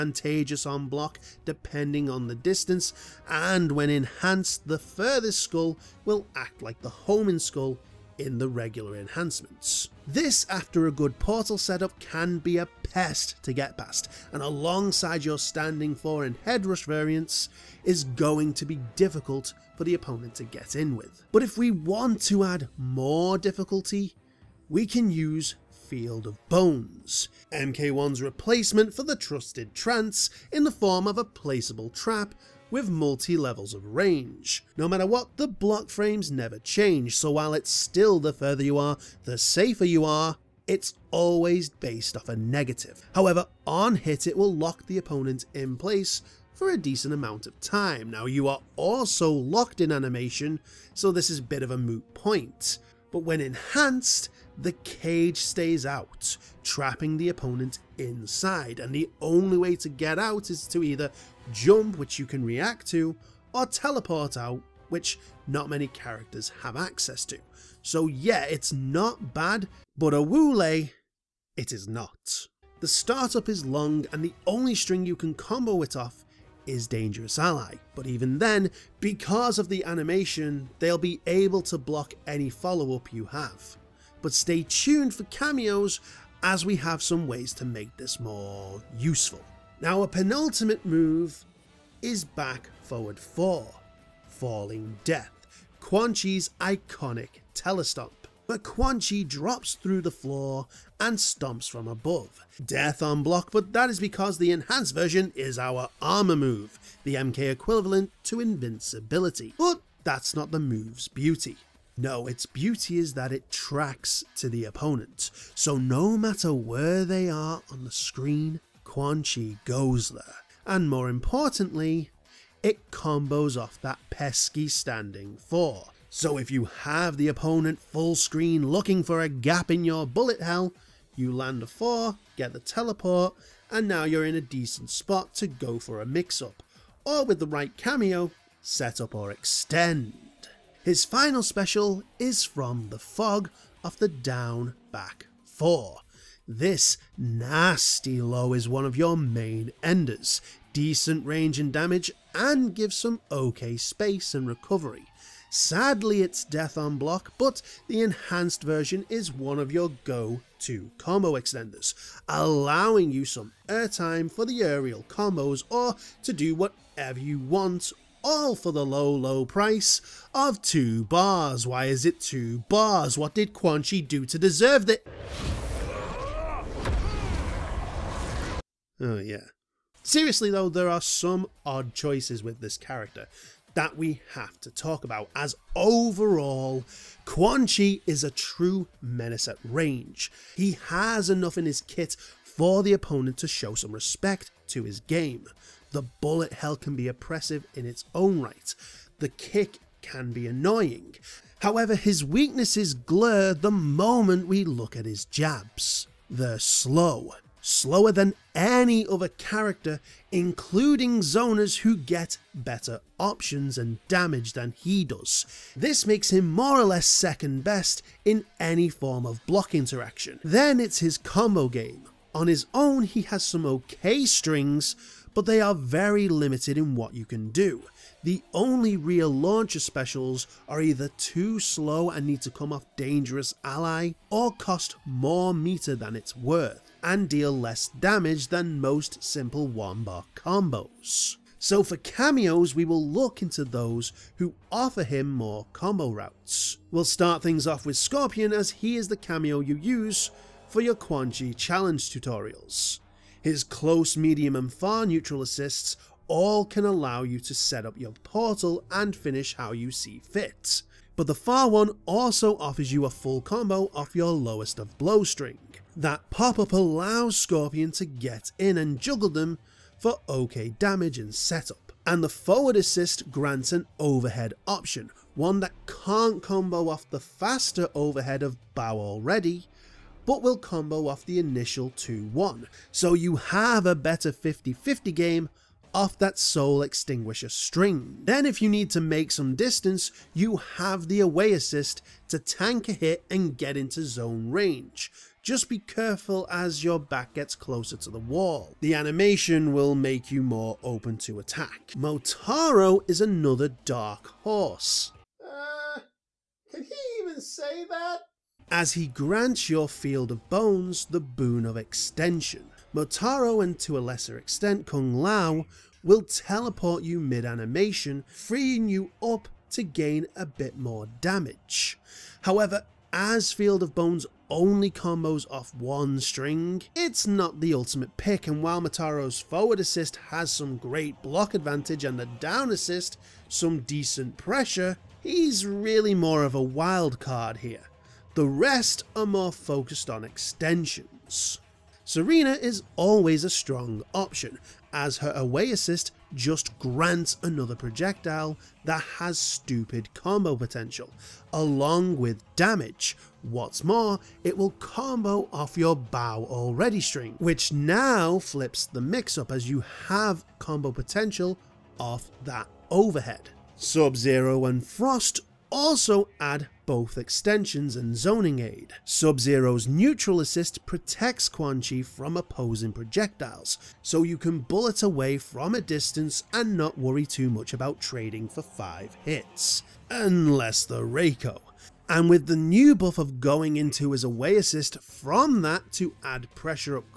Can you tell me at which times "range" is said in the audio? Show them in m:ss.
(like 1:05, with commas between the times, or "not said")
0:33, 2:31, 3:09, 4:54.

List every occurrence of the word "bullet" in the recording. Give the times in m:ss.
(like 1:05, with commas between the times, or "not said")
2:10, 3:16, 6:14.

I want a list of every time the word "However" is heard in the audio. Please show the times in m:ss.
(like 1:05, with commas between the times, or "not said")
0:43, 3:21, 5:22.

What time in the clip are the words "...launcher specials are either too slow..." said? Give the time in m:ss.
3:49.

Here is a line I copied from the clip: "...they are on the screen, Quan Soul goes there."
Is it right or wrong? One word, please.
wrong.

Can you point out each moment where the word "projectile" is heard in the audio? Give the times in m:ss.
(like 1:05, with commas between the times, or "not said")
5:47, 6:12.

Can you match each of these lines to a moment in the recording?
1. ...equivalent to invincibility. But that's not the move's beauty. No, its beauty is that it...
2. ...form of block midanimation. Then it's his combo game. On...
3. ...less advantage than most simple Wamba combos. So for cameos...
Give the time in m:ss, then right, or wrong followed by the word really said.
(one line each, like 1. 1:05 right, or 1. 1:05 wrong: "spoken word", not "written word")
1. 1:47 right
2. 3:38 wrong: "interaction", not "midanimation"
3. 3:57 wrong: "damage", not "advantage".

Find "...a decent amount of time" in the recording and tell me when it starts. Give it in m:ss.
0:46.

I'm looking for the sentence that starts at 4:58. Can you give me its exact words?
The animation will make you more open to attack.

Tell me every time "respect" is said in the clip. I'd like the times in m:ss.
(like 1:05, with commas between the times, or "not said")
3:13.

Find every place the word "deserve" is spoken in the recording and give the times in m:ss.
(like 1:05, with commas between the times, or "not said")
2:54.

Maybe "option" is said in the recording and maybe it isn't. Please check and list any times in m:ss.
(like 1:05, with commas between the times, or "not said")
3:33, 4:34, 5:44.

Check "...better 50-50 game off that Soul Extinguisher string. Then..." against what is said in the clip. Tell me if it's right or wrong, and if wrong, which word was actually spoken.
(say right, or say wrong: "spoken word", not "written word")
right.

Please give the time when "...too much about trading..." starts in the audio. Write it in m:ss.
6:17.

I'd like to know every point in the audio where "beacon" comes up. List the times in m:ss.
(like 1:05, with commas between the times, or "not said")
not said.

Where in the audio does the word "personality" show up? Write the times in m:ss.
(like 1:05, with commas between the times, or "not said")
not said.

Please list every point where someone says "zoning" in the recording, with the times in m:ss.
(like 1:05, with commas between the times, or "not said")
6:08.